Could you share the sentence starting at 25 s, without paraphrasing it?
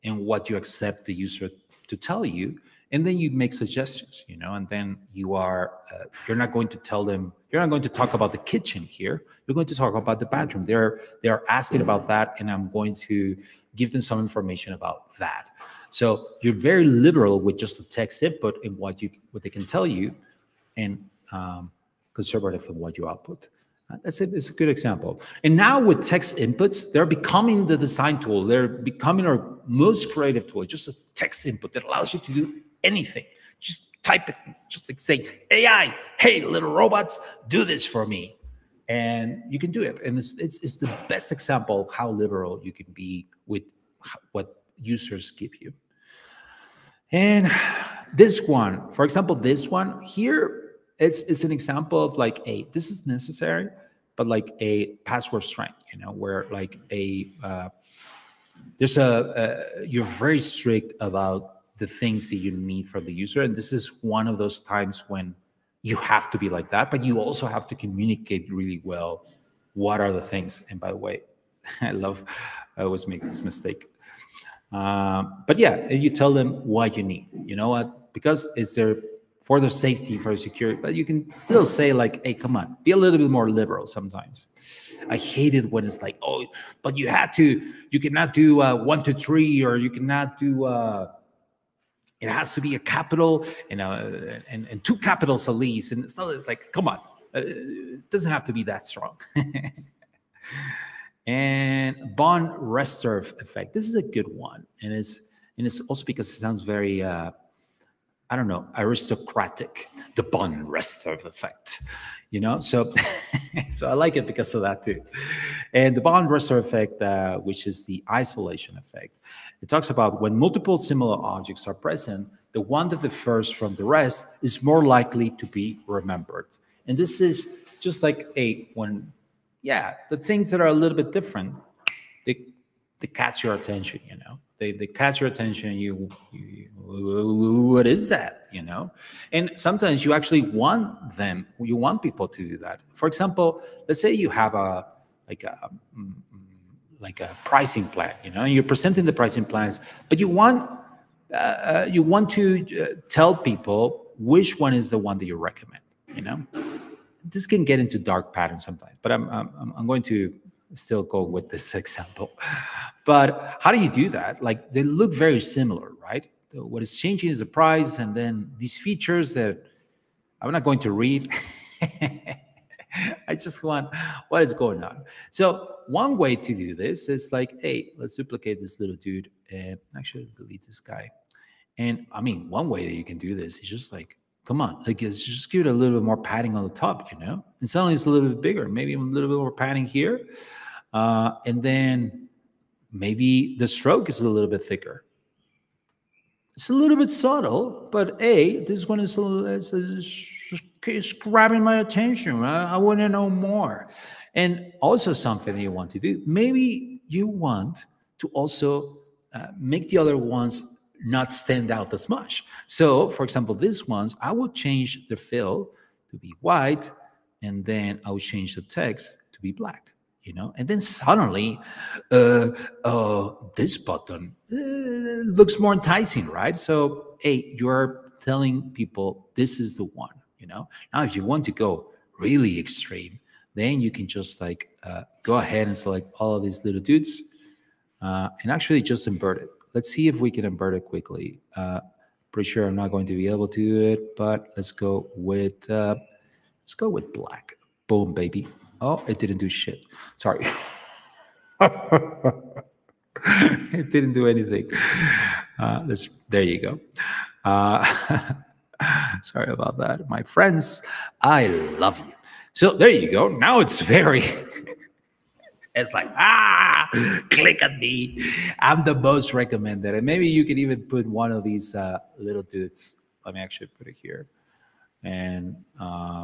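And now with text inputs, they're becoming the design tool.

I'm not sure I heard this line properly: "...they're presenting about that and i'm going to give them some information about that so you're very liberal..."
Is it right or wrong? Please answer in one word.
wrong.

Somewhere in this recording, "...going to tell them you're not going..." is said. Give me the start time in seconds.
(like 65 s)
6 s.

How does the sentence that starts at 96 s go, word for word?
It's like, come on, uh, it doesn't have to be that strong.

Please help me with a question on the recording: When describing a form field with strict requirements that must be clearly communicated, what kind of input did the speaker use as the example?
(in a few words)
Password strength.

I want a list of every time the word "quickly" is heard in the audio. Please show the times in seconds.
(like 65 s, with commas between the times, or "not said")
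240 s.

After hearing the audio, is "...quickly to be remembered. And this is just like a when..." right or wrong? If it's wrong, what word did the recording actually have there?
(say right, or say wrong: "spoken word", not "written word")
wrong: "likely", not "quickly".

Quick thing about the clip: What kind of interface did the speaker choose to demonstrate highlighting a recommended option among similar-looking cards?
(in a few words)
Pricing plan.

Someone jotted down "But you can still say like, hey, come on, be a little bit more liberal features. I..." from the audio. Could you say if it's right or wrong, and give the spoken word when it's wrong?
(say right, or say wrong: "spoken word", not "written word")
wrong: "sometimes", not "features".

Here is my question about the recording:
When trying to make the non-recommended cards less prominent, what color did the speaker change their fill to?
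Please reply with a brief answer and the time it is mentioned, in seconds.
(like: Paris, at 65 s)
White, at 216 s.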